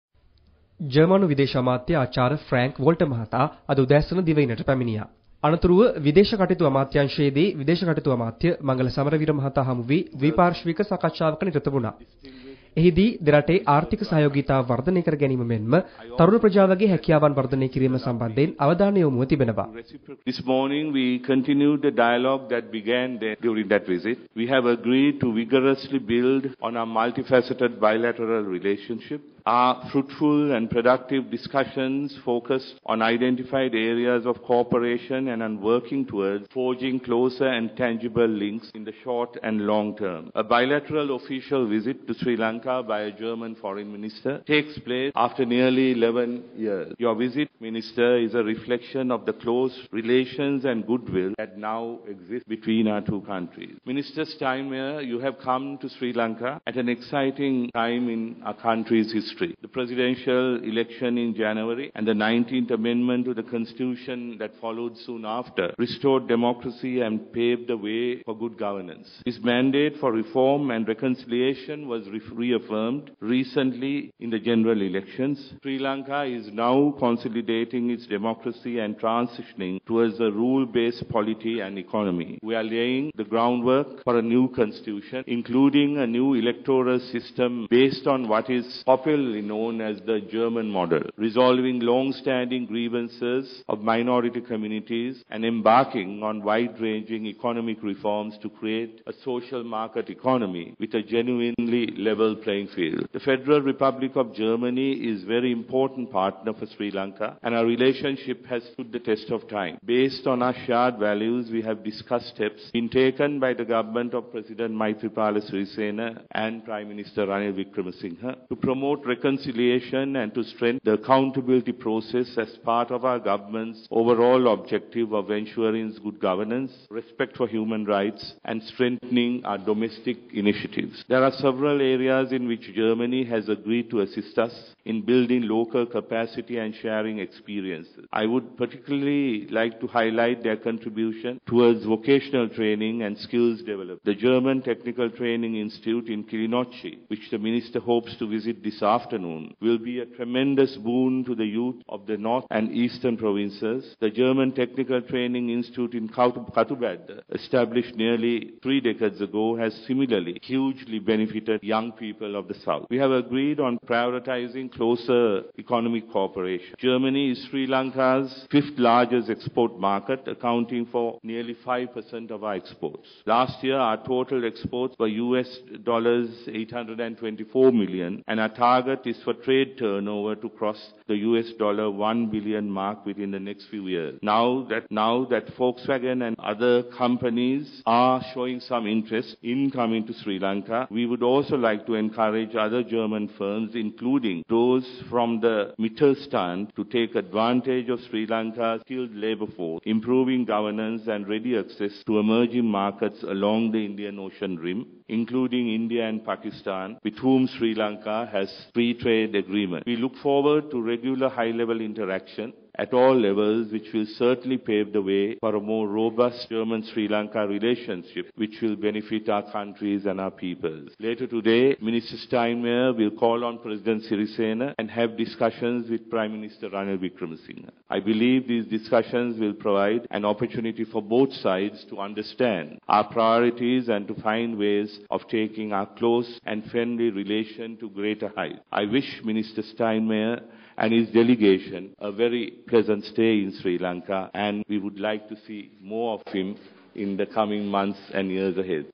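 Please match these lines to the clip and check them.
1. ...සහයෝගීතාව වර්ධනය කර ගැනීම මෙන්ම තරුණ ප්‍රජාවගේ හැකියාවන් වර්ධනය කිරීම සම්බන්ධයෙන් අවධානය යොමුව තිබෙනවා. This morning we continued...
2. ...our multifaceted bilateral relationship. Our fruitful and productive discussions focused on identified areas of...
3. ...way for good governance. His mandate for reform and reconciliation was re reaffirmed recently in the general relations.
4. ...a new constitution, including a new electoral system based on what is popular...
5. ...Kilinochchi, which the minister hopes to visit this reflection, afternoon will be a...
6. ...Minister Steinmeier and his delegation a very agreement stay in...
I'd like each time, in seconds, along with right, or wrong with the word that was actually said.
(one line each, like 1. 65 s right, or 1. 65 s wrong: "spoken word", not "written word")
1. 14 s right
2. 26 s right
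3. 67 s wrong: "elections", not "relations"
4. 84 s right
5. 146 s wrong: "afternoon", not "reflection"
6. 239 s wrong: "pleasant", not "agreement".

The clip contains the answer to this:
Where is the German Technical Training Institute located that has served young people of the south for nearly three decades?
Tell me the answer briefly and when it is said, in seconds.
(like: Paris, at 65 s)
Katubedda, at 156 s.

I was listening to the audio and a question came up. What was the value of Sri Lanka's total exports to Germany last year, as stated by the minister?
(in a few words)
US$824 million.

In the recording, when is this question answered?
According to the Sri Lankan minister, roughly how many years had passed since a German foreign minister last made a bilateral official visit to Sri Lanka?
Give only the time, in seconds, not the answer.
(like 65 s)
45 s.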